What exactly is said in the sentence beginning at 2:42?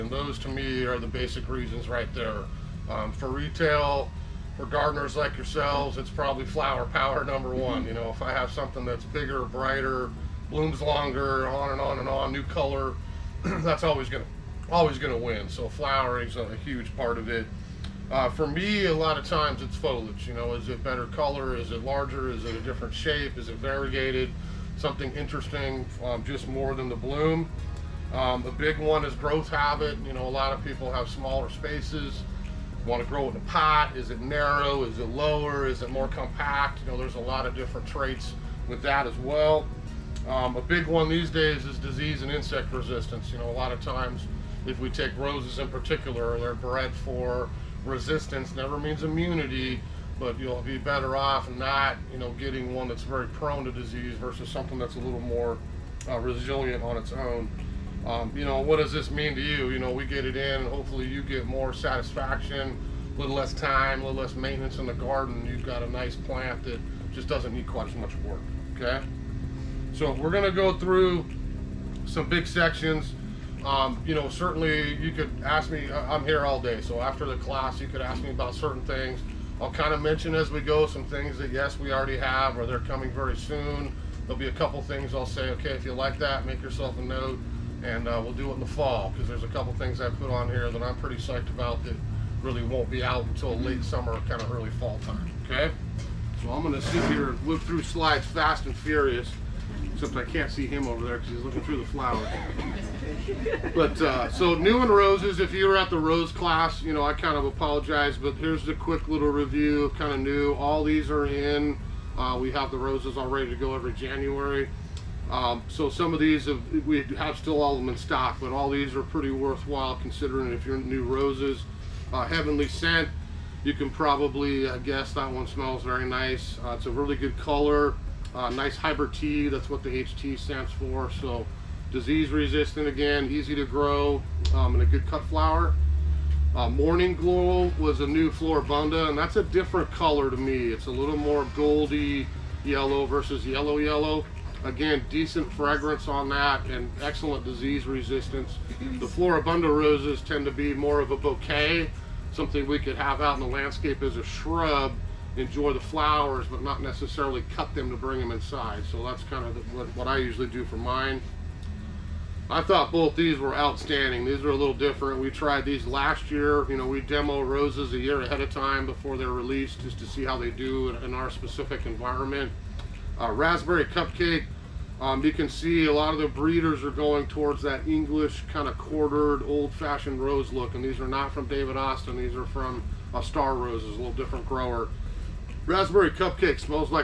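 I thought both these were outstanding.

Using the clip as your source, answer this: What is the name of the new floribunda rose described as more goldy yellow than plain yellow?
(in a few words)
Morning Glow.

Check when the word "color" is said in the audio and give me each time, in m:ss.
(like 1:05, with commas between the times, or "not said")
0:12, 0:21, 2:07, 2:19.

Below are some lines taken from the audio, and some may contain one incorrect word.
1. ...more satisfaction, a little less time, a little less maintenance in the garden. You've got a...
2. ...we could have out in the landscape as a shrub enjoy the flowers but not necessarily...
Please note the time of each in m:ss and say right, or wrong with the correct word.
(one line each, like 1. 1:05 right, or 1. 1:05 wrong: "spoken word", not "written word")
1. 1:01 right
2. 2:32 right.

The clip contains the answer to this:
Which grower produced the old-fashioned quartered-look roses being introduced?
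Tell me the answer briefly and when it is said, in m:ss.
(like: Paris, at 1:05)
Star Roses, at 3:03.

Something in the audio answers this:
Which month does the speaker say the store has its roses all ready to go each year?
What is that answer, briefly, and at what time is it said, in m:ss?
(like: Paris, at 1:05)
January, at 1:53.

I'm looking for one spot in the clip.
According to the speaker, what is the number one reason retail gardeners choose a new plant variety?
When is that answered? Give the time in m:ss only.
0:06.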